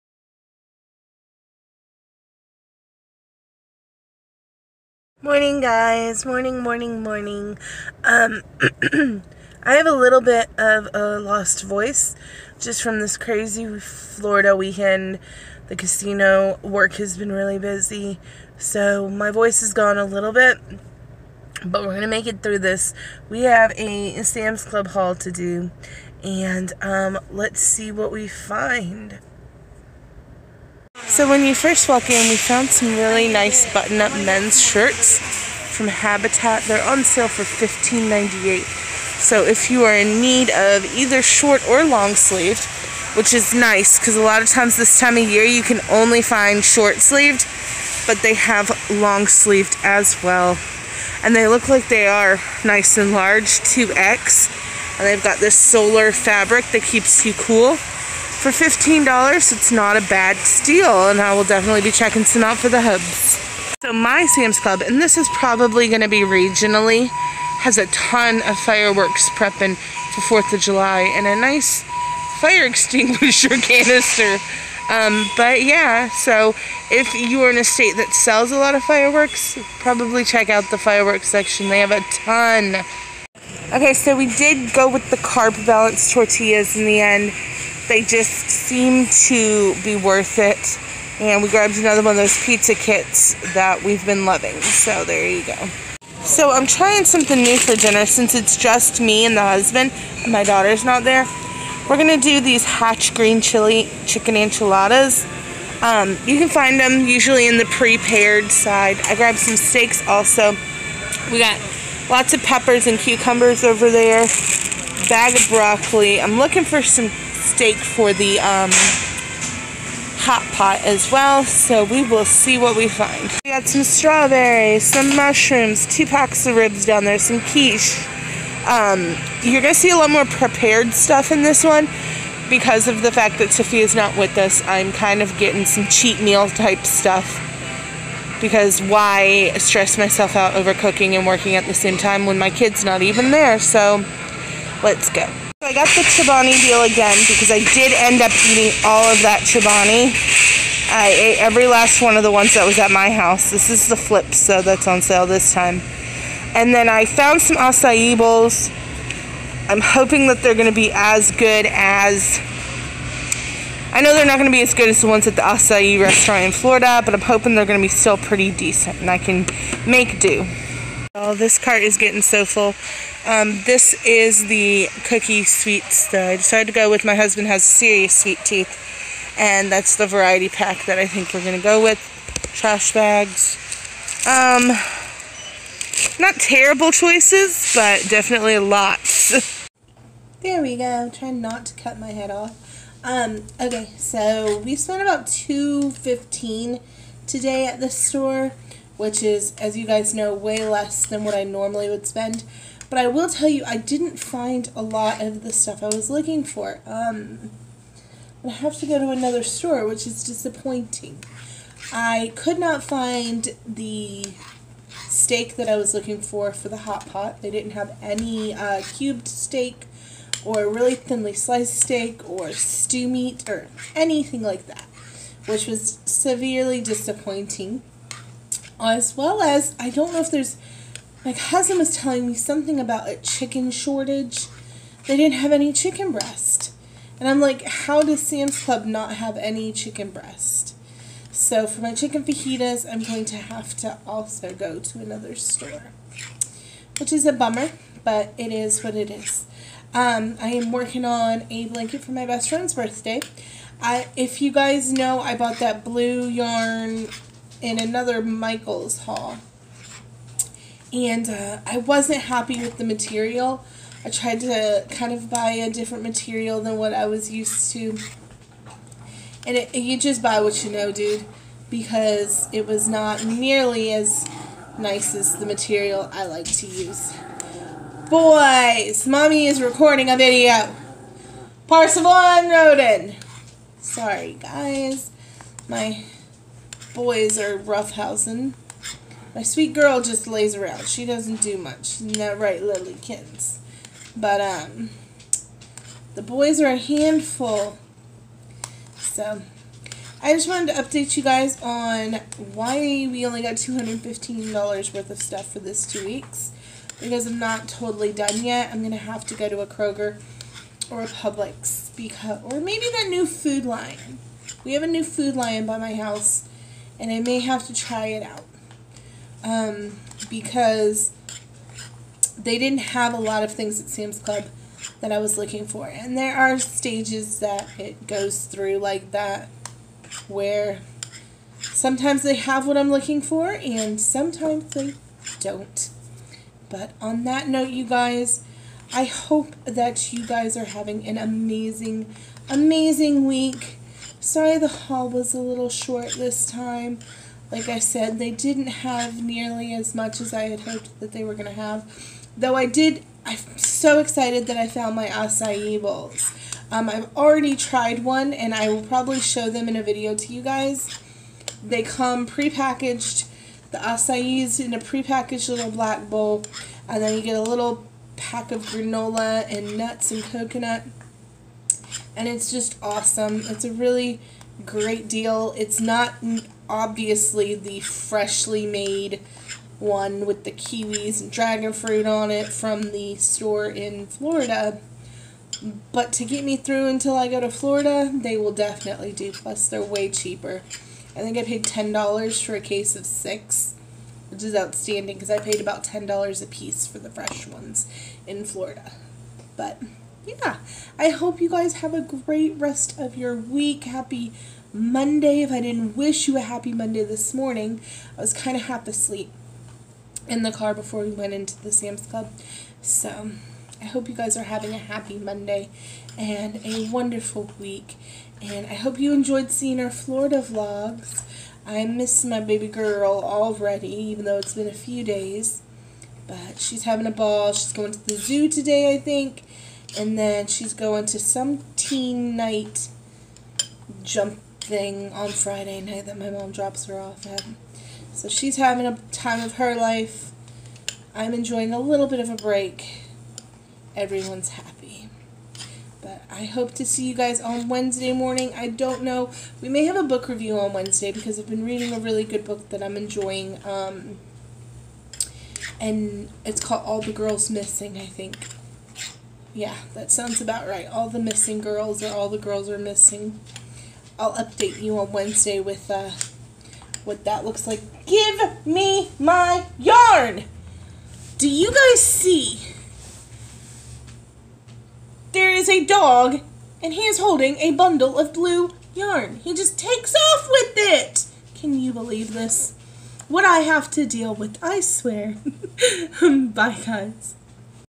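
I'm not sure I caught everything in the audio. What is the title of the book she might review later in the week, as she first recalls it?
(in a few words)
All the Girls Missing.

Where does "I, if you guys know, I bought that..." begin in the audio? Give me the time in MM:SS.
04:13.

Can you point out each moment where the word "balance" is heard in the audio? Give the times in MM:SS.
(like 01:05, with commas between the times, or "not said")
01:25.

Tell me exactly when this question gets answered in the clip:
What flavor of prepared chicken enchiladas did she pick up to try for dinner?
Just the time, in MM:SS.
01:42.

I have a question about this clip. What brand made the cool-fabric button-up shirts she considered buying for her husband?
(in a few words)
Habitat.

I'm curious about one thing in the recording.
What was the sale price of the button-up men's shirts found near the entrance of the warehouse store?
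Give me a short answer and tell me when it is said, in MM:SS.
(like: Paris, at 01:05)
$15.98, at 00:37.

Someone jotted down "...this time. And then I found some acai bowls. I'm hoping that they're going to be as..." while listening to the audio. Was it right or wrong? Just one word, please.
right.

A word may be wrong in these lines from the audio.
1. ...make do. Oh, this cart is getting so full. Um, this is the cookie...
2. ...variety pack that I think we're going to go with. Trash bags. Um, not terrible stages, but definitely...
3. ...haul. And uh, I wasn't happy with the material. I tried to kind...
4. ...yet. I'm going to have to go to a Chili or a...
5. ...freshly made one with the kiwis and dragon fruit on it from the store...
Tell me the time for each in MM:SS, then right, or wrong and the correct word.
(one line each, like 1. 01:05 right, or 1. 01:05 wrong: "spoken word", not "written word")
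1. 02:49 right
2. 03:00 wrong: "choices", not "stages"
3. 04:19 right
4. 05:08 wrong: "Kroger", not "Chili"
5. 06:17 right.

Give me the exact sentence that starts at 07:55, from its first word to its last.
There is a dog, and he is holding a bundle of blue yarn.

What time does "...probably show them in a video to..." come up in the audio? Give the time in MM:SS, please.
05:58.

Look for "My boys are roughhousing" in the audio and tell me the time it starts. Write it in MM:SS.
04:45.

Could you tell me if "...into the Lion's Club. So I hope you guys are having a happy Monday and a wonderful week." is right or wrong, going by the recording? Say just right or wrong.
wrong.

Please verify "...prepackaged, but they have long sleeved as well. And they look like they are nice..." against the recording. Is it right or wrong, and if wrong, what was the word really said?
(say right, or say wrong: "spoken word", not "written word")
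wrong: "sleeved", not "prepackaged".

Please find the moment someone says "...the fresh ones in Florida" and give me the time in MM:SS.
06:36.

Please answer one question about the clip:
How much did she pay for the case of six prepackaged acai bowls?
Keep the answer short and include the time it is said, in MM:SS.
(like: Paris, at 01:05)
$10, at 06:31.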